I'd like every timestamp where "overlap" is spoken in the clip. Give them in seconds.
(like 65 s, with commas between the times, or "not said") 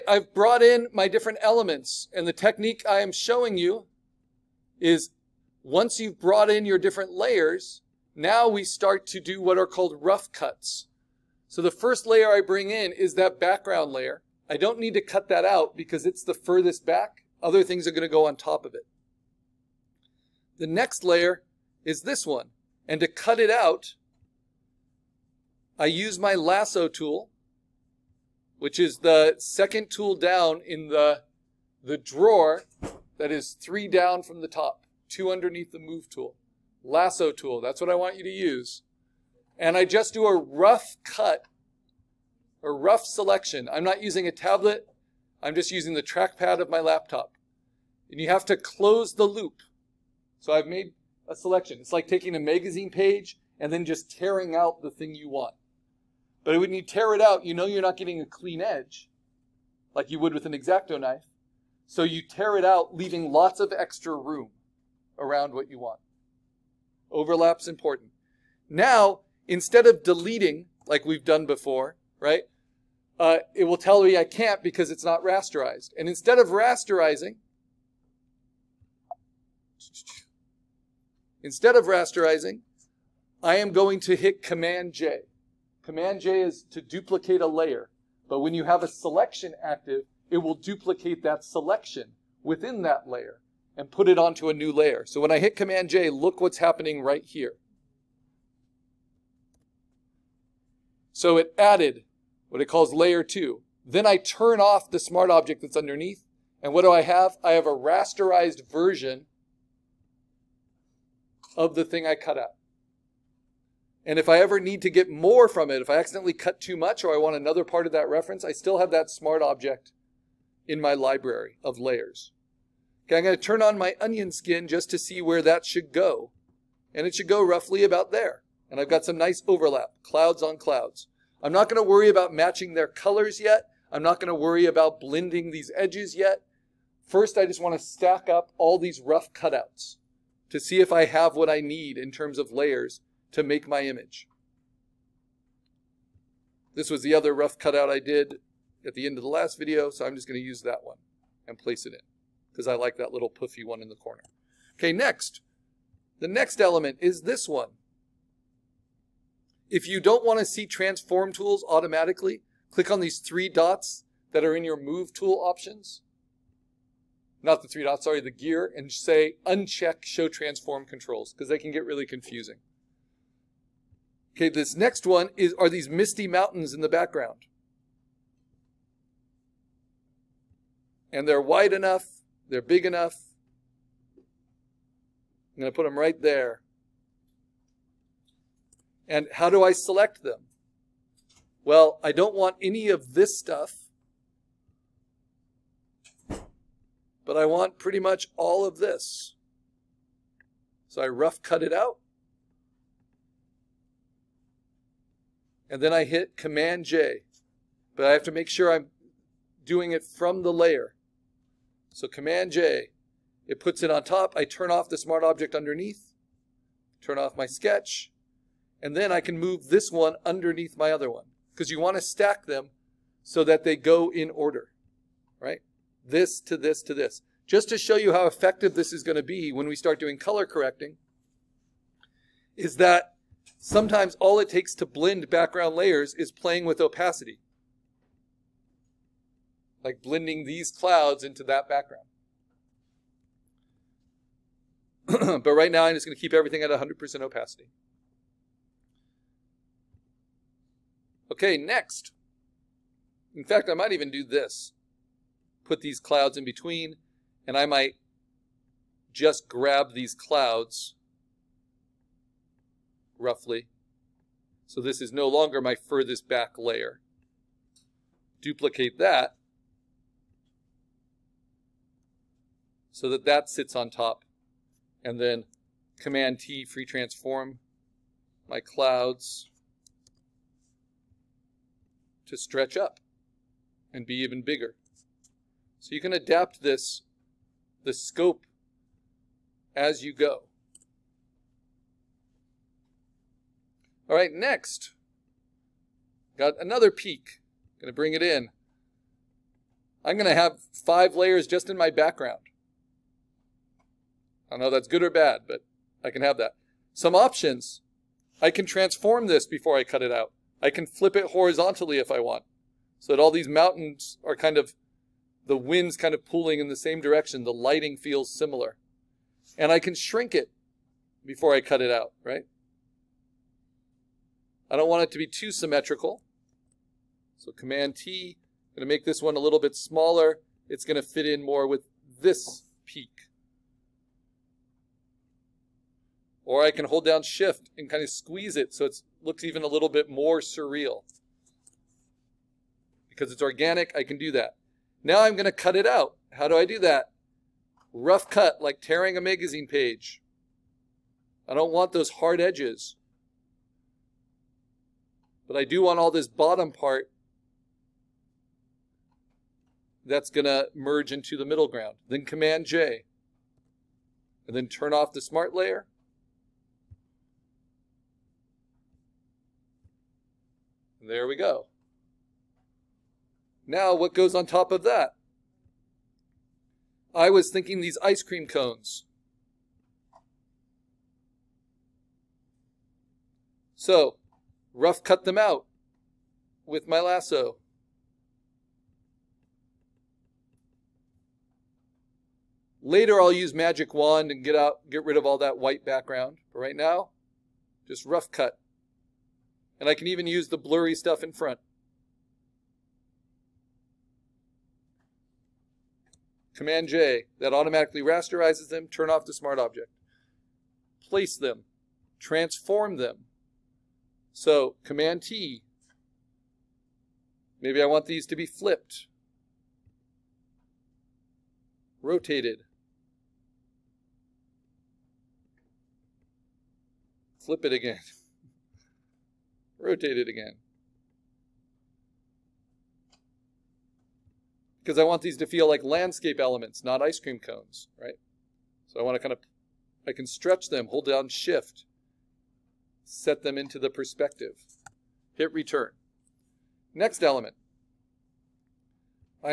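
67 s, 129 s.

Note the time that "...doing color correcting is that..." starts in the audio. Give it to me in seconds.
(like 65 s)
229 s.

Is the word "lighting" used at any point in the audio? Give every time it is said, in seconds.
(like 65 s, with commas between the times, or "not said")
317 s.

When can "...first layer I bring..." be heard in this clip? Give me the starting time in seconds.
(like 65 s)
11 s.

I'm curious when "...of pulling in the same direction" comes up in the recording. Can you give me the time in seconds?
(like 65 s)
316 s.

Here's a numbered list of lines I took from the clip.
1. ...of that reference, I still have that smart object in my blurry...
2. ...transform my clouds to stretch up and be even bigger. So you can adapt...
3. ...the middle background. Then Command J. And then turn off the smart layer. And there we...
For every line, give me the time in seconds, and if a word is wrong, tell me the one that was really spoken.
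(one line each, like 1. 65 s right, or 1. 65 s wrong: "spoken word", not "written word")
1. 117 s wrong: "library", not "blurry"
2. 276 s right
3. 361 s wrong: "ground", not "background".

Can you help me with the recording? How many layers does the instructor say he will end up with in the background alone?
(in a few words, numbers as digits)
5.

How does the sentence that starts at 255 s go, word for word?
Put these clouds in between, and I might just grab these clouds roughly.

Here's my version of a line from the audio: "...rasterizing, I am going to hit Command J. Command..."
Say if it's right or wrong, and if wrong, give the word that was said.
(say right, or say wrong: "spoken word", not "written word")
right.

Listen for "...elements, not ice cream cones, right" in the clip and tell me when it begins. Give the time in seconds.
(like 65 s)
436 s.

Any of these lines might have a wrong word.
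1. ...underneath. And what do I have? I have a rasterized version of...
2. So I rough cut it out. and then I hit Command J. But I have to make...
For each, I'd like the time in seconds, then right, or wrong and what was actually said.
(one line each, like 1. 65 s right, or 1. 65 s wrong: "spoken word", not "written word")
1. 105 s right
2. 200 s right.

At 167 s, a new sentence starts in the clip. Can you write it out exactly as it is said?
Not the three dots, sorry, the gear, and say uncheck show transform controls because they can get really confusing.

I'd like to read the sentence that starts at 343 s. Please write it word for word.
Because it's organic, I can do that.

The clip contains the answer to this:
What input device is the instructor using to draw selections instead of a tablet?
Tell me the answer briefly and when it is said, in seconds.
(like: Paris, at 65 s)
Trackpad, at 46 s.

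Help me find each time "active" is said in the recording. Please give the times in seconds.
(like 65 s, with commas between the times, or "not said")
89 s.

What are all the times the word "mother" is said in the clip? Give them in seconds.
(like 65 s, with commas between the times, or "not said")
not said.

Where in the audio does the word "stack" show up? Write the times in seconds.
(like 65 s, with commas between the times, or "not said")
137 s, 222 s.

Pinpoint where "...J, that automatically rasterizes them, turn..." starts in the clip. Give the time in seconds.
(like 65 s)
406 s.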